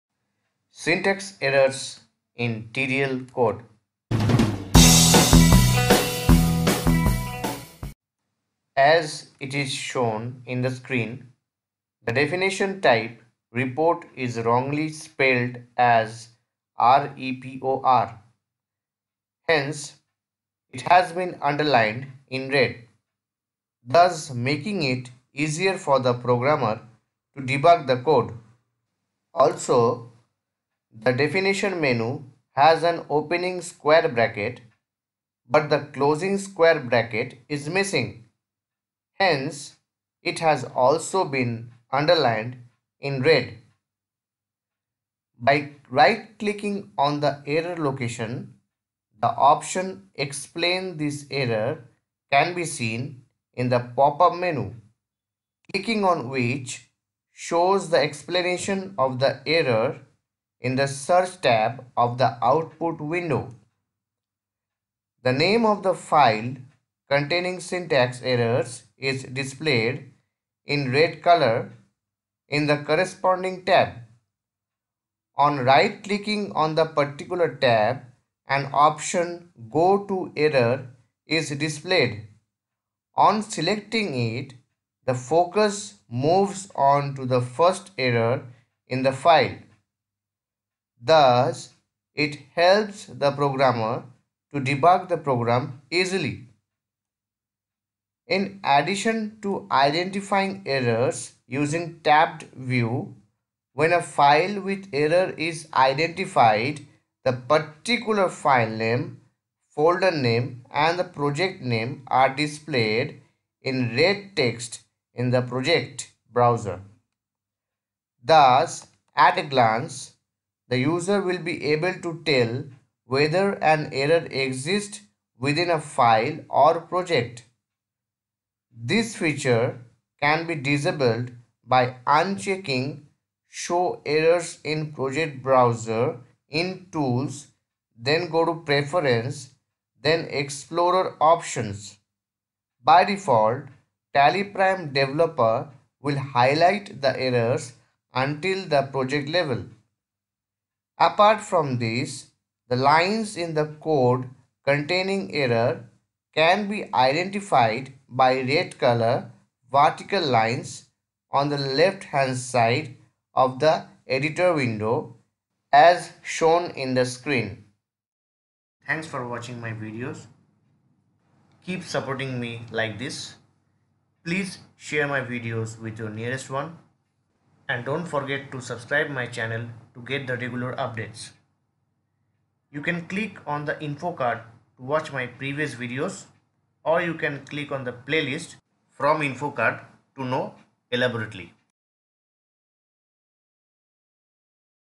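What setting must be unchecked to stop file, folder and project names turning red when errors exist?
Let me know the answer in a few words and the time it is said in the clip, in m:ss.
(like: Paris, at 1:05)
show errors in project browser, at 2:13.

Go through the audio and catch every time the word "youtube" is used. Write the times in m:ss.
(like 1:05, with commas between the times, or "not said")
not said.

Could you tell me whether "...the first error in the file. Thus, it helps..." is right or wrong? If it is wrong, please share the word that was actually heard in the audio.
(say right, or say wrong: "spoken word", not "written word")
right.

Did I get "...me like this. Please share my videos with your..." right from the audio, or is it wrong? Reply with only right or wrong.
right.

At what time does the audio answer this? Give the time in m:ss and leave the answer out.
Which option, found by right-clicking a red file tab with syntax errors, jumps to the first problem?
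1:19.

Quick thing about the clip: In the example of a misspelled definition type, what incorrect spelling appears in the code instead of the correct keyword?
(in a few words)
REPOR.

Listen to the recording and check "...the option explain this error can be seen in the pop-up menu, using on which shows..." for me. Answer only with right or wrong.
wrong.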